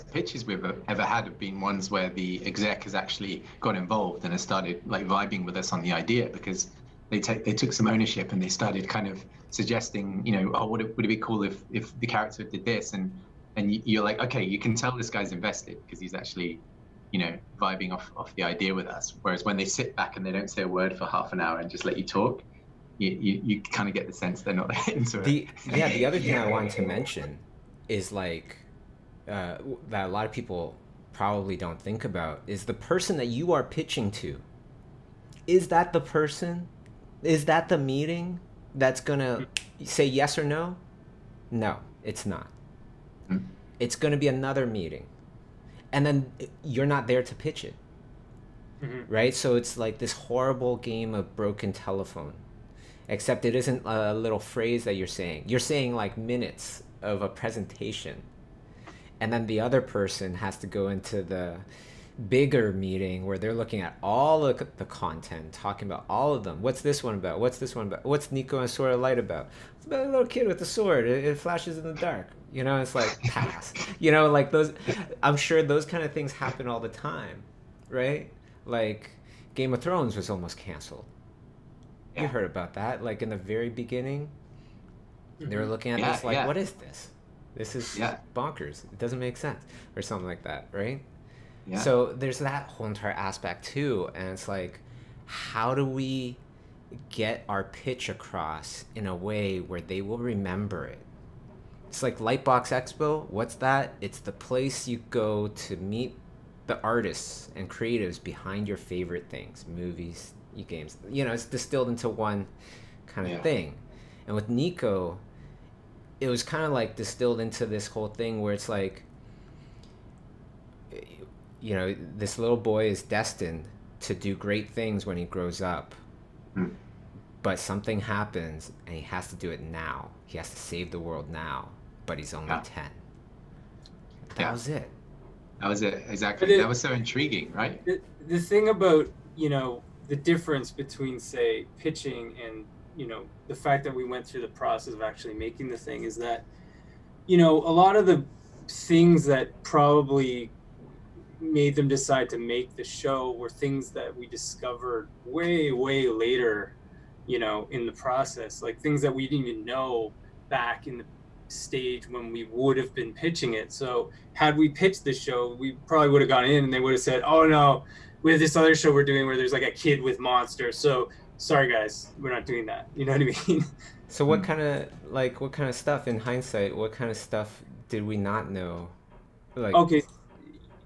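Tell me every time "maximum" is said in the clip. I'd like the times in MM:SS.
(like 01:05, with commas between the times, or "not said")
not said.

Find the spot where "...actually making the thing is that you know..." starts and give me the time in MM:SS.
02:25.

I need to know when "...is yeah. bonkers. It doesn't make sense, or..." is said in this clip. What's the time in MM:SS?
01:27.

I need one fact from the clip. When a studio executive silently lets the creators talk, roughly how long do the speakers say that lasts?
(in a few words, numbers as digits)
half an hour.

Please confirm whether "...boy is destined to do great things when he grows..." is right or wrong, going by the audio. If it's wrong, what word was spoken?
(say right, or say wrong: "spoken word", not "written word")
right.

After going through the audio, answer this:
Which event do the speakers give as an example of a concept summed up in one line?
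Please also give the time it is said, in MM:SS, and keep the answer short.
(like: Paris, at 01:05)
Lightbox Expo, at 01:42.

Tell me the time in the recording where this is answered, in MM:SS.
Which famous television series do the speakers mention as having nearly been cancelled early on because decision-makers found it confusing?
01:19.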